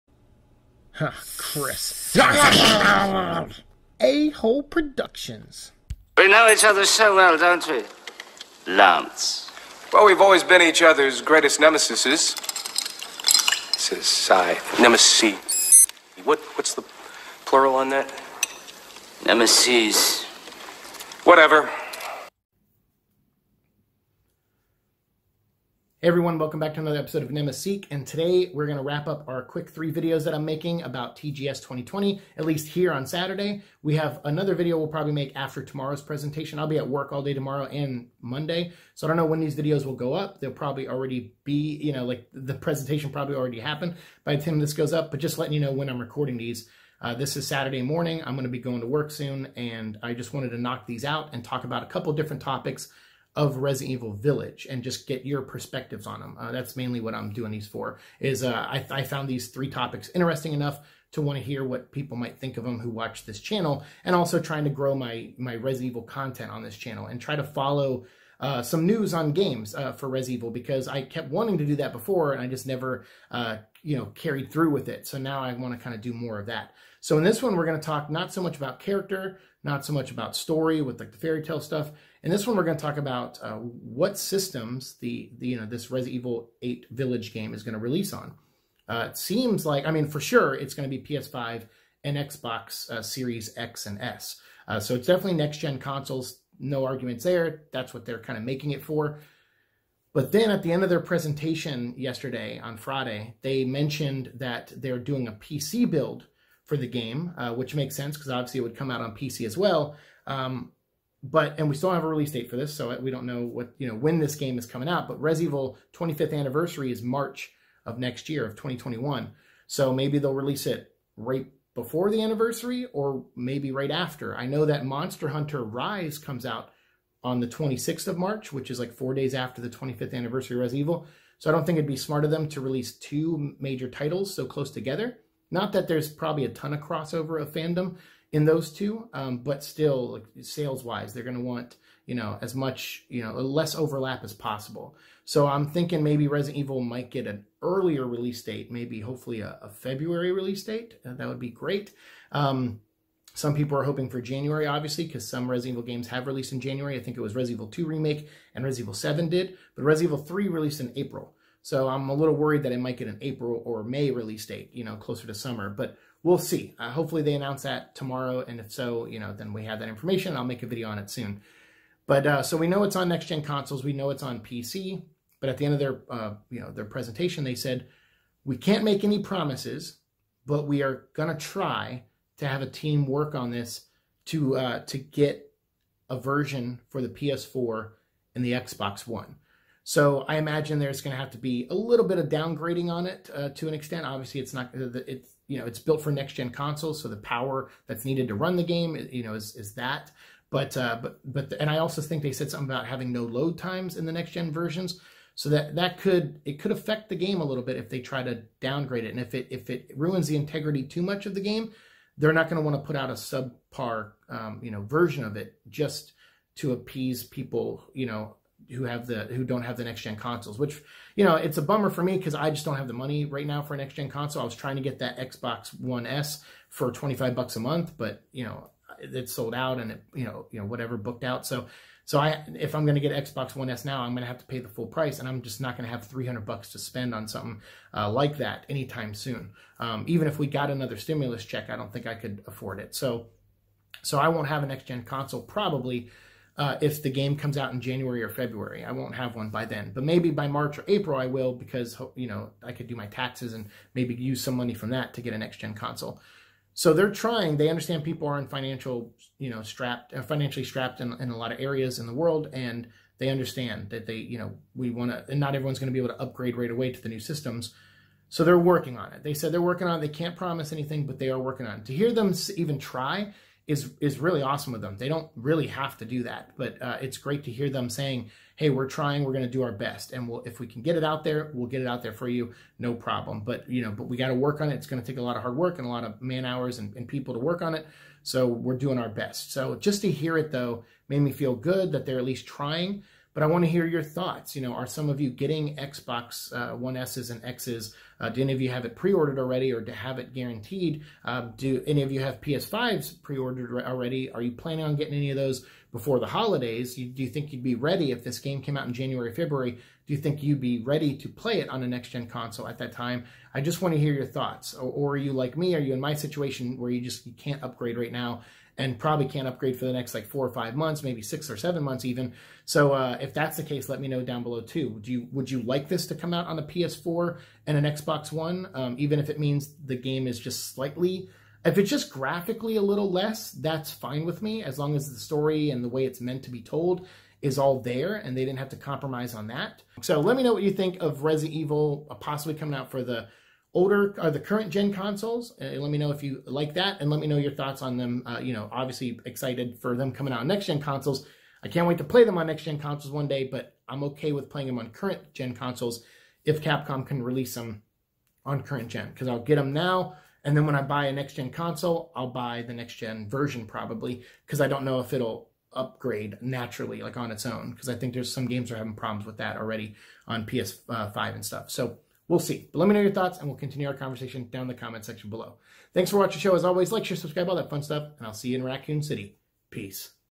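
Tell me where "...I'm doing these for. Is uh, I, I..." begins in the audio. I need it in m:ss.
0:57.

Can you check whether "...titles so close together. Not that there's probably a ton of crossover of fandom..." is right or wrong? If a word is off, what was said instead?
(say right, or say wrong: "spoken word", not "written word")
right.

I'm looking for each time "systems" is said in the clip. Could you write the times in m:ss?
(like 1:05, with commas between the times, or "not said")
1:24, 4:27.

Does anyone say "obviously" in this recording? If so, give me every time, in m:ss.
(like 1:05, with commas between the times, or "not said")
1:48, 2:34, 3:14, 5:48.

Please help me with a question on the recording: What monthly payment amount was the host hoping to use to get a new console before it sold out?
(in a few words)
$25.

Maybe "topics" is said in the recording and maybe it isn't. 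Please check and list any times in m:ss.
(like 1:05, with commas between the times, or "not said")
0:52, 0:59.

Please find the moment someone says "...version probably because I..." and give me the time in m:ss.
6:03.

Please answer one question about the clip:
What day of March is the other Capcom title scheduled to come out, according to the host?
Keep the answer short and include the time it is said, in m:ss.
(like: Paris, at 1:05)
26th, at 2:07.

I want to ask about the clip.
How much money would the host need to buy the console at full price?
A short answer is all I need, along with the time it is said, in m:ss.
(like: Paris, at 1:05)
$300, at 3:56.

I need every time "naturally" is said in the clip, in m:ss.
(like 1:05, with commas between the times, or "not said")
6:06.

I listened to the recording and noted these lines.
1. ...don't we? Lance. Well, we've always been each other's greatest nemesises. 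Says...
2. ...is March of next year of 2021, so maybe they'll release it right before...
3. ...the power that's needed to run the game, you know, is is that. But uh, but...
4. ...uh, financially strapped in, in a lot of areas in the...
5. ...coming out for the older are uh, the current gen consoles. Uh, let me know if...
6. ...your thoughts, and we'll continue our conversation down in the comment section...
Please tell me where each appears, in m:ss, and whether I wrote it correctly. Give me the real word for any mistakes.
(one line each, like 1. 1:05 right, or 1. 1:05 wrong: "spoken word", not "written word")
1. 0:07 right
2. 1:56 right
3. 3:17 right
4. 4:20 right
5. 5:42 right
6. 6:13 right.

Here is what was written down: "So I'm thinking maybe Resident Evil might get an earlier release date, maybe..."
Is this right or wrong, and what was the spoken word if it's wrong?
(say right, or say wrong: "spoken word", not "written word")
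right.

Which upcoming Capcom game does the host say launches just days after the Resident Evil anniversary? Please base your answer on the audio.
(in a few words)
Monster Hunter Rise.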